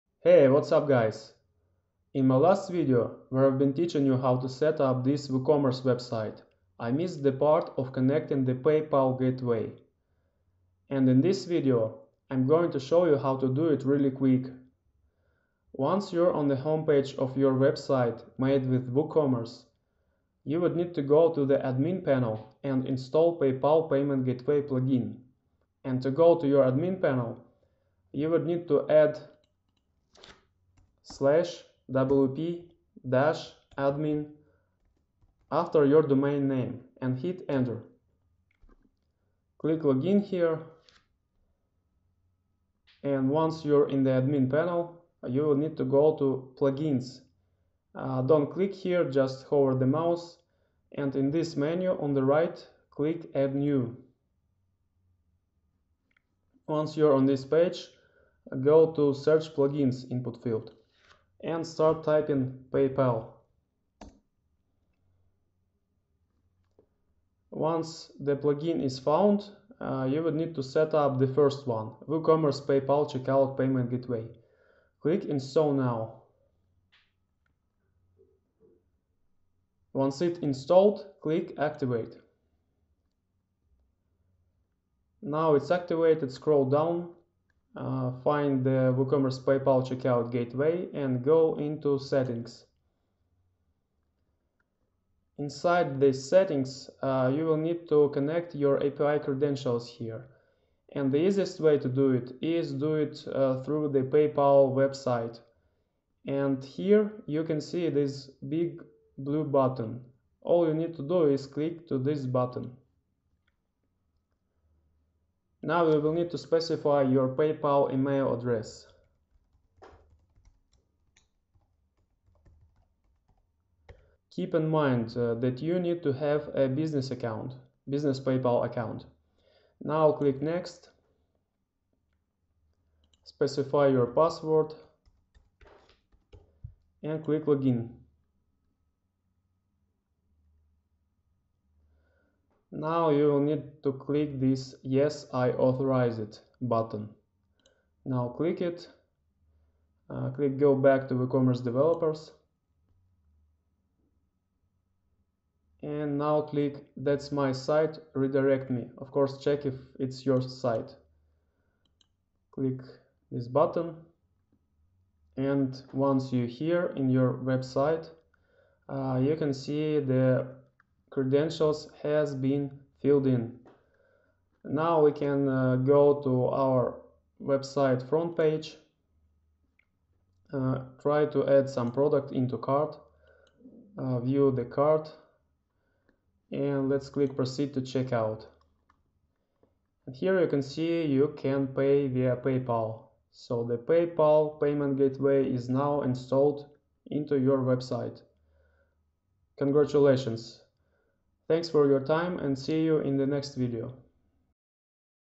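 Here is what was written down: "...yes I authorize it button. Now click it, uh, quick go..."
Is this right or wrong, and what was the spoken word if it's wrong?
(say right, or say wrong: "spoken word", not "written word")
wrong: "click", not "quick".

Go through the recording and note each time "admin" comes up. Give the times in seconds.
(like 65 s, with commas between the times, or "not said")
21 s, 26 s, 33 s, 44 s.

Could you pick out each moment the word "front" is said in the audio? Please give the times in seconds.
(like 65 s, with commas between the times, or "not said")
178 s.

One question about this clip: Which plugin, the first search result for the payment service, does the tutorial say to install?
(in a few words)
WooCommerce PayPal Checkout Payment Gateway.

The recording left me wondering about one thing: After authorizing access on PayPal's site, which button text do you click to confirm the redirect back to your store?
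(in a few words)
That's my site, redirect me.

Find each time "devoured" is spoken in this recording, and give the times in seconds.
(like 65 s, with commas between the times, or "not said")
not said.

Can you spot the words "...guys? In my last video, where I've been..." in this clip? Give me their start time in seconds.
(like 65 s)
0 s.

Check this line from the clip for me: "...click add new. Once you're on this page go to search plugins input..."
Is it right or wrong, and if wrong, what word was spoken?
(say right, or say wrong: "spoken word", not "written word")
right.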